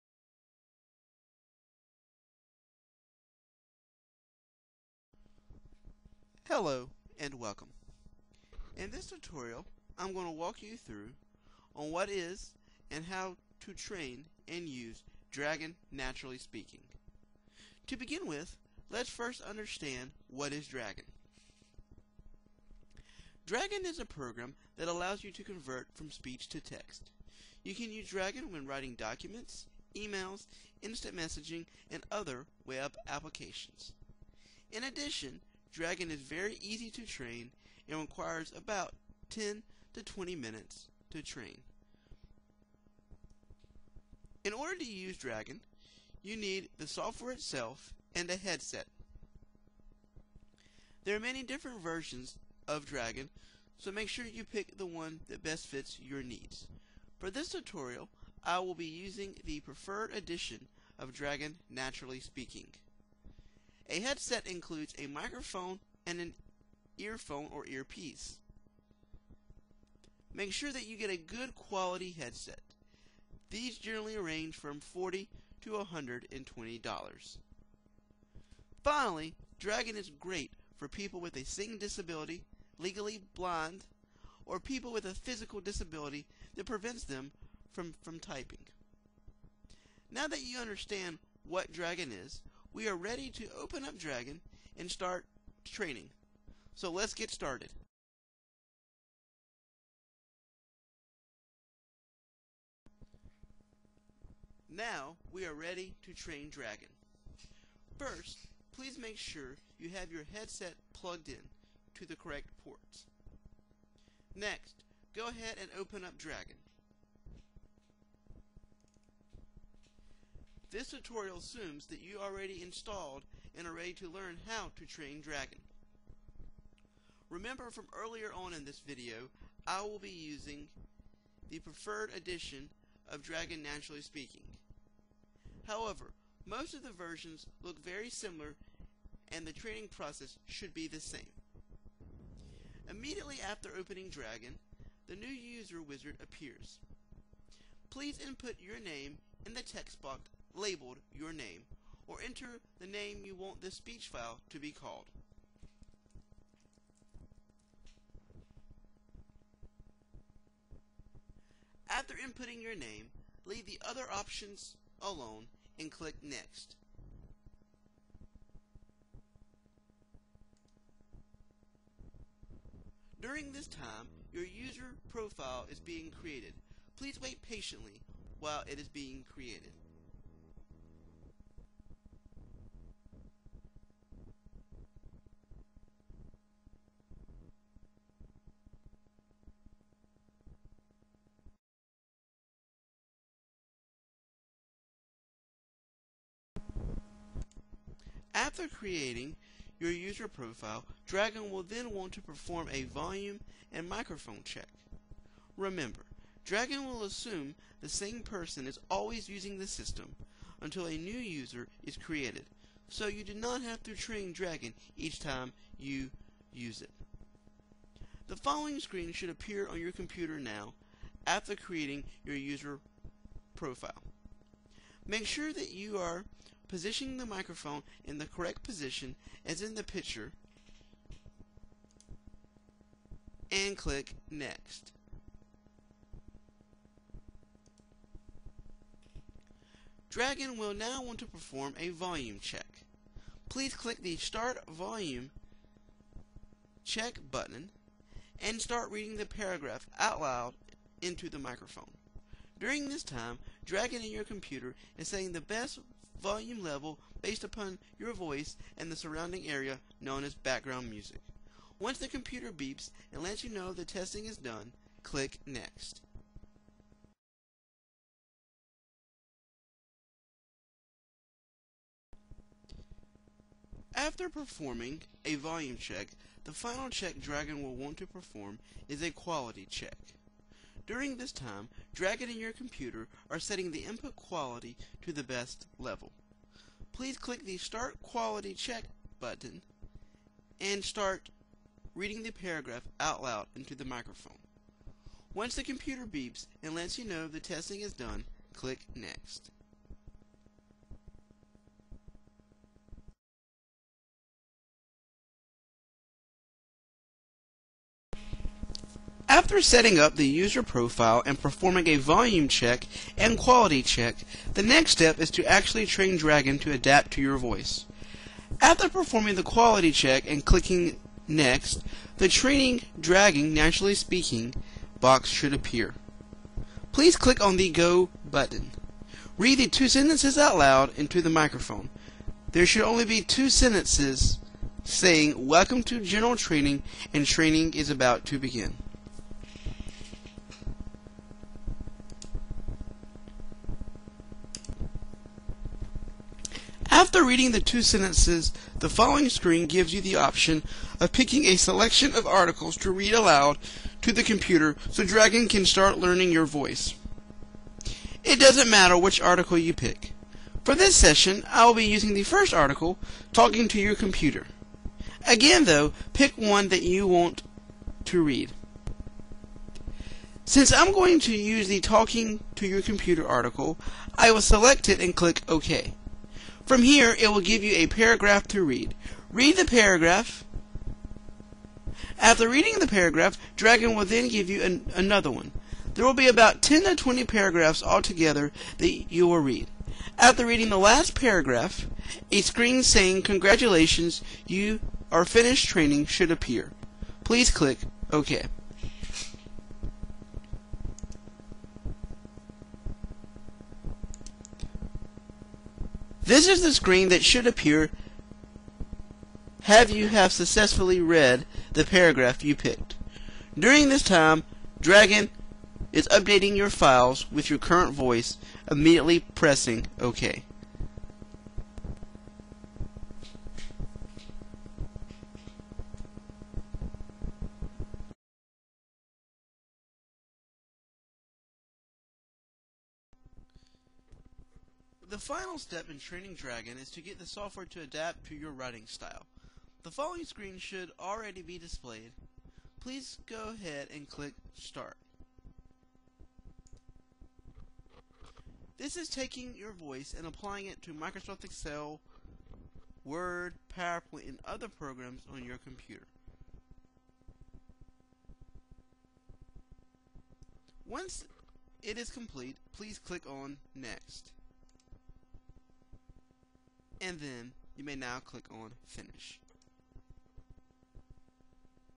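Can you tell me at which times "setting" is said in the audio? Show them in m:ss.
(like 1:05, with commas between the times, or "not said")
4:43, 5:09.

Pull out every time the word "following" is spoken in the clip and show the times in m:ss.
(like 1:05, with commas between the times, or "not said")
3:38, 5:48, 7:19.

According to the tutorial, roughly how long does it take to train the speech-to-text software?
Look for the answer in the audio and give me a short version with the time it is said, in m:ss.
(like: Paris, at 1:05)
10 to 20 minutes, at 0:39.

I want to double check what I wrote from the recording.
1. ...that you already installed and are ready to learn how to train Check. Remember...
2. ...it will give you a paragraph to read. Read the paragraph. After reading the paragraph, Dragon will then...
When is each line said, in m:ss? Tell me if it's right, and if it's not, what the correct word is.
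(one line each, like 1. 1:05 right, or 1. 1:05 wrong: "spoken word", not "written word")
1. 2:01 wrong: "Dragon", not "Check"
2. 6:17 right.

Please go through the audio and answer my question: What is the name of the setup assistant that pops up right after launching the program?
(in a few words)
New user wizard.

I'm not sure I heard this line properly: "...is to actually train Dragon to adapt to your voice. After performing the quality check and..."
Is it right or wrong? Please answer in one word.
right.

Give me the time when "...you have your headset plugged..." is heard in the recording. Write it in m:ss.
1:49.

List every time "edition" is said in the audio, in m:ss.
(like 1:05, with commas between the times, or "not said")
1:00, 2:12.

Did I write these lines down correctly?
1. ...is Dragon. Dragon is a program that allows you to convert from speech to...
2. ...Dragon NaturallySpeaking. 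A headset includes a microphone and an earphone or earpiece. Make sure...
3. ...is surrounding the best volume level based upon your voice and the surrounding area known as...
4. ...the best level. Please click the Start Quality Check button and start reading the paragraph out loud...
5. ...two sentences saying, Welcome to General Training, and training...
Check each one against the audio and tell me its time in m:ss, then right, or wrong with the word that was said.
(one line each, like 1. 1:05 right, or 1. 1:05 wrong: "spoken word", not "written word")
1. 0:20 right
2. 1:01 right
3. 4:14 wrong: "saying", not "surrounding"
4. 4:45 right
5. 5:33 right.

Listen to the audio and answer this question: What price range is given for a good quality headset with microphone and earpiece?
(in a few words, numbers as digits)
$40 to $120.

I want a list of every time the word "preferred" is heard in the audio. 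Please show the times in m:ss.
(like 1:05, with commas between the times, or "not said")
0:59, 2:11.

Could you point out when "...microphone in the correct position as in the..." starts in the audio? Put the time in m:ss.
3:47.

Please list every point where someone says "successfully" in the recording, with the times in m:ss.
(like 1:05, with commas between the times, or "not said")
6:50.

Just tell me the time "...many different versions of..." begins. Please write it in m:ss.
0:51.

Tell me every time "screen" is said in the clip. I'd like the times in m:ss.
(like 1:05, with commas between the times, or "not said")
3:38, 5:49, 6:32, 6:46, 7:20.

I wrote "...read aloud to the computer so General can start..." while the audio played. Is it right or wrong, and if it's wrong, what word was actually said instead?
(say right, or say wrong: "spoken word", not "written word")
wrong: "Dragon", not "General".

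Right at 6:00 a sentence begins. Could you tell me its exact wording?
For this session, I will be using the first article, Talking to Your Computer.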